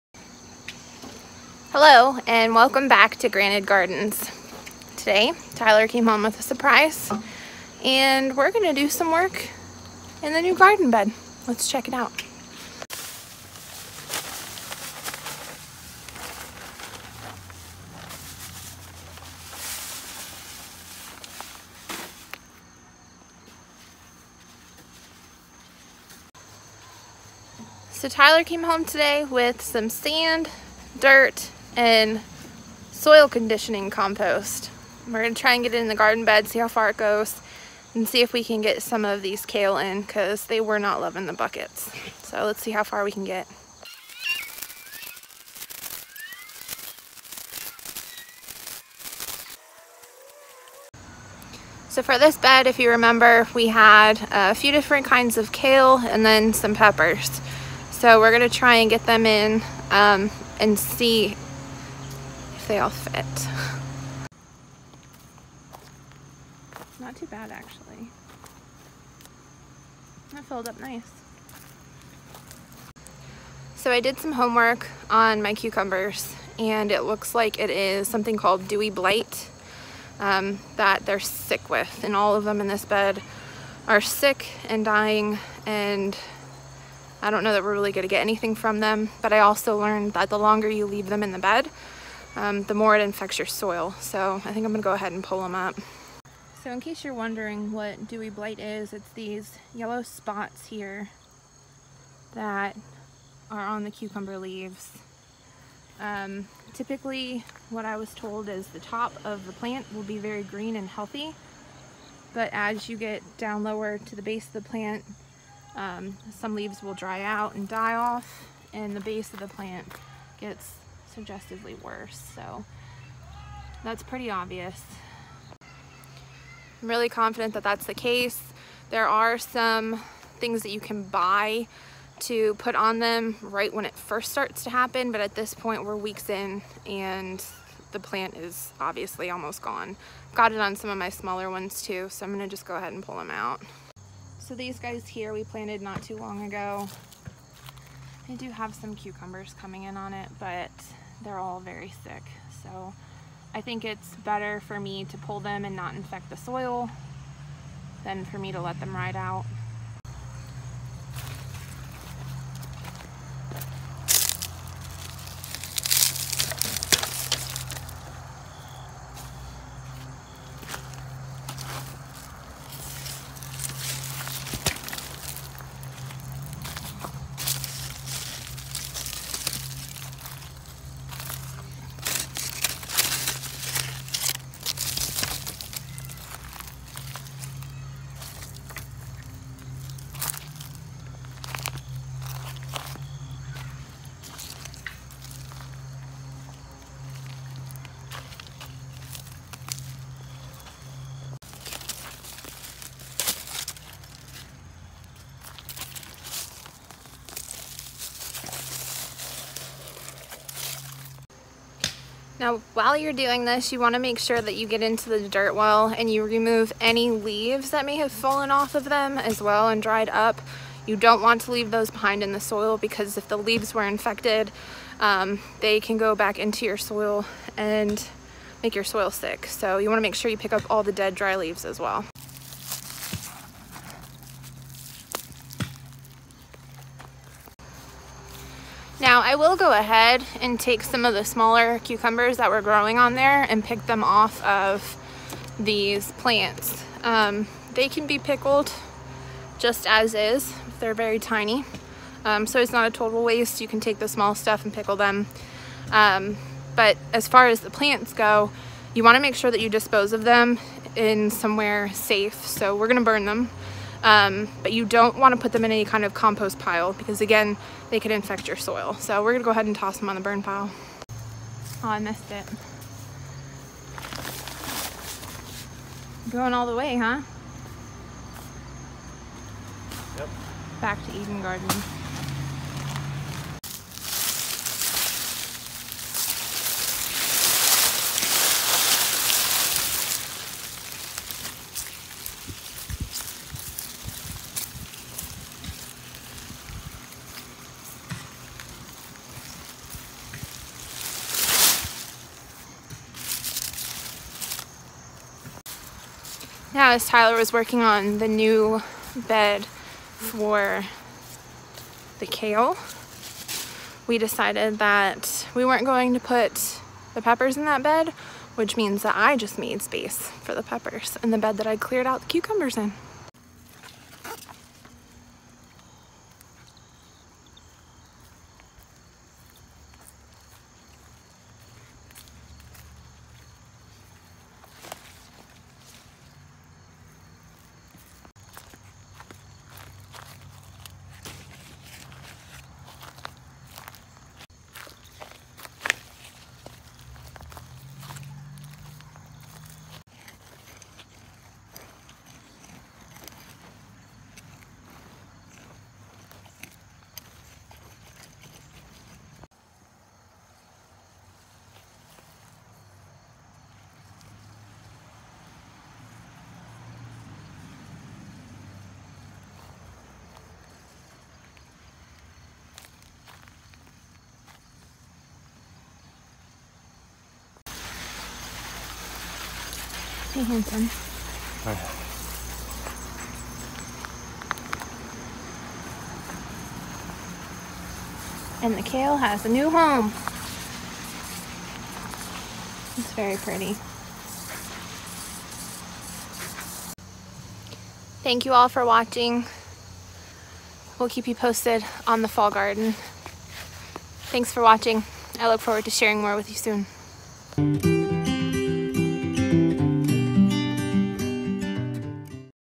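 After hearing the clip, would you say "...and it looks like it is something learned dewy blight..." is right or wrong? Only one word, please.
wrong.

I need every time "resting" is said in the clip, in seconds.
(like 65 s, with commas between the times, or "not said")
not said.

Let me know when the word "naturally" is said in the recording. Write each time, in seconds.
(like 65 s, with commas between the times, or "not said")
not said.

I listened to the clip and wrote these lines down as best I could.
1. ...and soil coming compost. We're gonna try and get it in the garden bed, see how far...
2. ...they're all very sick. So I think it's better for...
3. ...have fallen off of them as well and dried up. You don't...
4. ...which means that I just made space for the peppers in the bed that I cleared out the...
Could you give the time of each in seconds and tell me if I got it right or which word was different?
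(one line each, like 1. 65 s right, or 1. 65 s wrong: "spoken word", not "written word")
1. 31 s wrong: "conditioning", not "coming"
2. 151 s right
3. 217 s right
4. 318 s right.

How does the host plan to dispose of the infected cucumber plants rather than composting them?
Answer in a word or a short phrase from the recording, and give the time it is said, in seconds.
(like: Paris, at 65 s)
burn them, at 263 s.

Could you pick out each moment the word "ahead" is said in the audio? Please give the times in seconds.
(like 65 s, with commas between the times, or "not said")
94 s, 142 s, 239 s, 269 s.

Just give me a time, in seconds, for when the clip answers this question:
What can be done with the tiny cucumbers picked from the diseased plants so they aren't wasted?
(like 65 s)
248 s.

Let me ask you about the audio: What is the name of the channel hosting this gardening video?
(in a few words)
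Granted Gardens.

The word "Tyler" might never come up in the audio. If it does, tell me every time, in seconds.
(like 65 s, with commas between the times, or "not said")
5 s, 28 s, 307 s.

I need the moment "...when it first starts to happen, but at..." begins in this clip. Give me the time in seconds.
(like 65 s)
133 s.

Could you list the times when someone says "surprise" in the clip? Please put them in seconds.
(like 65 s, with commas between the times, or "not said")
6 s.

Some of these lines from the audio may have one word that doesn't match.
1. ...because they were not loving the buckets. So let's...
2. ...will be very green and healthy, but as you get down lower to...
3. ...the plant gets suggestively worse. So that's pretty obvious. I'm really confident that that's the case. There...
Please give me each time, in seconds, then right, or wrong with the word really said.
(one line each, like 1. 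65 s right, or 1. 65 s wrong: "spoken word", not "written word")
1. 40 s right
2. 109 s right
3. 119 s right.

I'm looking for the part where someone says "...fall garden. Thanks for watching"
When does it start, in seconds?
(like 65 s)
402 s.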